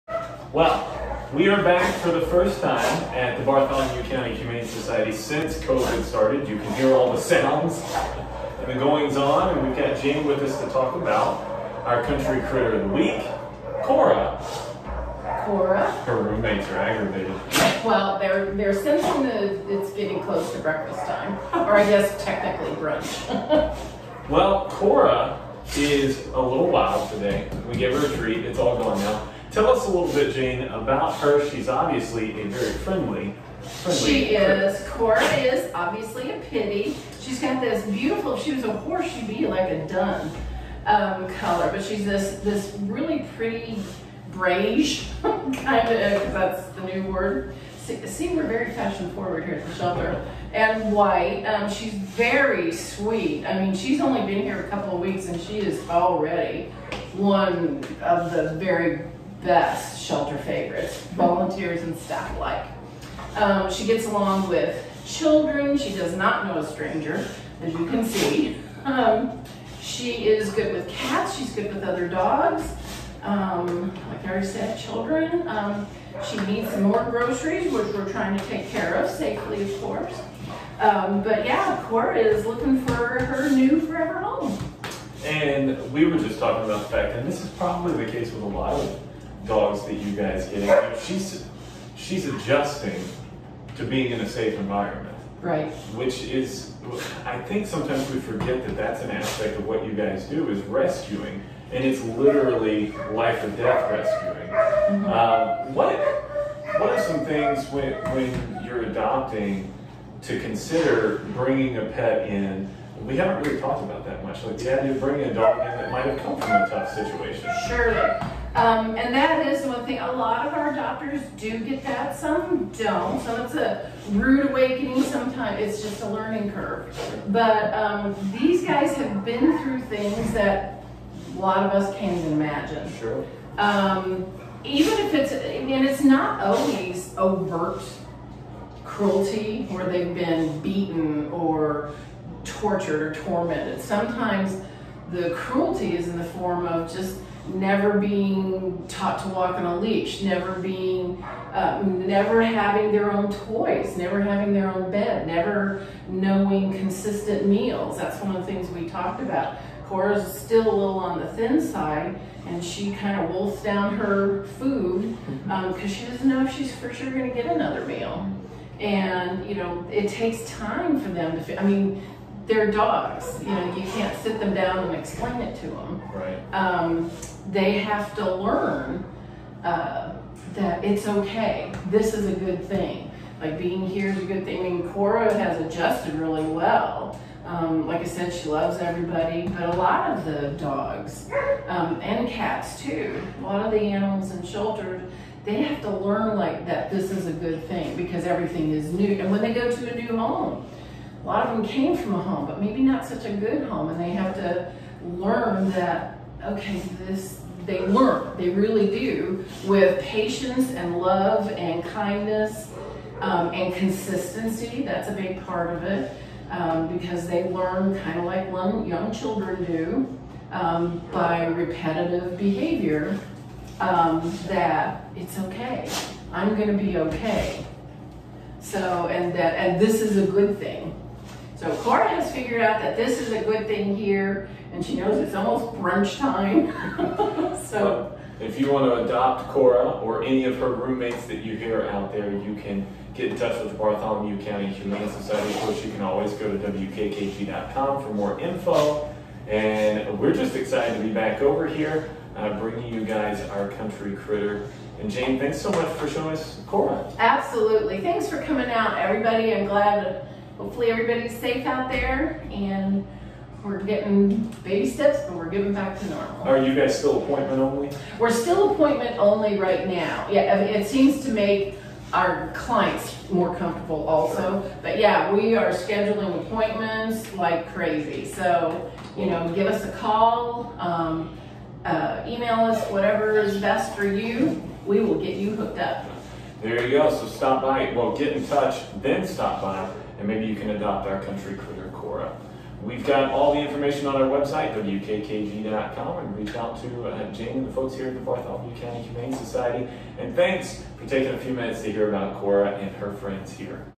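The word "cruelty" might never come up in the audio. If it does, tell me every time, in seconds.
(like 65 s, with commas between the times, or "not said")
138 s, 145 s.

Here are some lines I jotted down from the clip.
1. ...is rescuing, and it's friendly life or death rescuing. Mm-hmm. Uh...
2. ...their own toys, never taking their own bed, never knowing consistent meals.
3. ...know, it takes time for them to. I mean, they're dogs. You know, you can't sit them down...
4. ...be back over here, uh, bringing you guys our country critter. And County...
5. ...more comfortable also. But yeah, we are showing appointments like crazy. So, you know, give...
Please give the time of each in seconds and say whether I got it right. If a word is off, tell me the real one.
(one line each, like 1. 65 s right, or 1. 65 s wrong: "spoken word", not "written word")
1. 100 s wrong: "literally", not "friendly"
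2. 152 s wrong: "having", not "taking"
3. 169 s right
4. 251 s wrong: "Jane", not "County"
5. 273 s wrong: "scheduling", not "showing".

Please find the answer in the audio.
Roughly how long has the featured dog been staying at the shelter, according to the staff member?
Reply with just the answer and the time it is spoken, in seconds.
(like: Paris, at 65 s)
A couple of weeks, at 54 s.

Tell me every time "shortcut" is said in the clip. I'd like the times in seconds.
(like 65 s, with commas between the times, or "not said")
not said.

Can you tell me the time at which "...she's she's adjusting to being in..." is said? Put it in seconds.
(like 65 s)
91 s.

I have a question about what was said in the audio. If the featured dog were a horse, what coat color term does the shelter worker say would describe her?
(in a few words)
Dun.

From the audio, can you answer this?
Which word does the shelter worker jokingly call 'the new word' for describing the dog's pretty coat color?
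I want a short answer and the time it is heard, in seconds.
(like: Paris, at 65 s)
Beige, at 44 s.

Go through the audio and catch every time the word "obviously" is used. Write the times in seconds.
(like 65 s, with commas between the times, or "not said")
31 s, 35 s.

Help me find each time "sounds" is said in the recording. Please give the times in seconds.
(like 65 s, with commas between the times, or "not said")
7 s.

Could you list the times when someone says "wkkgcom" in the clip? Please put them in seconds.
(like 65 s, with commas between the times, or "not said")
246 s, 294 s.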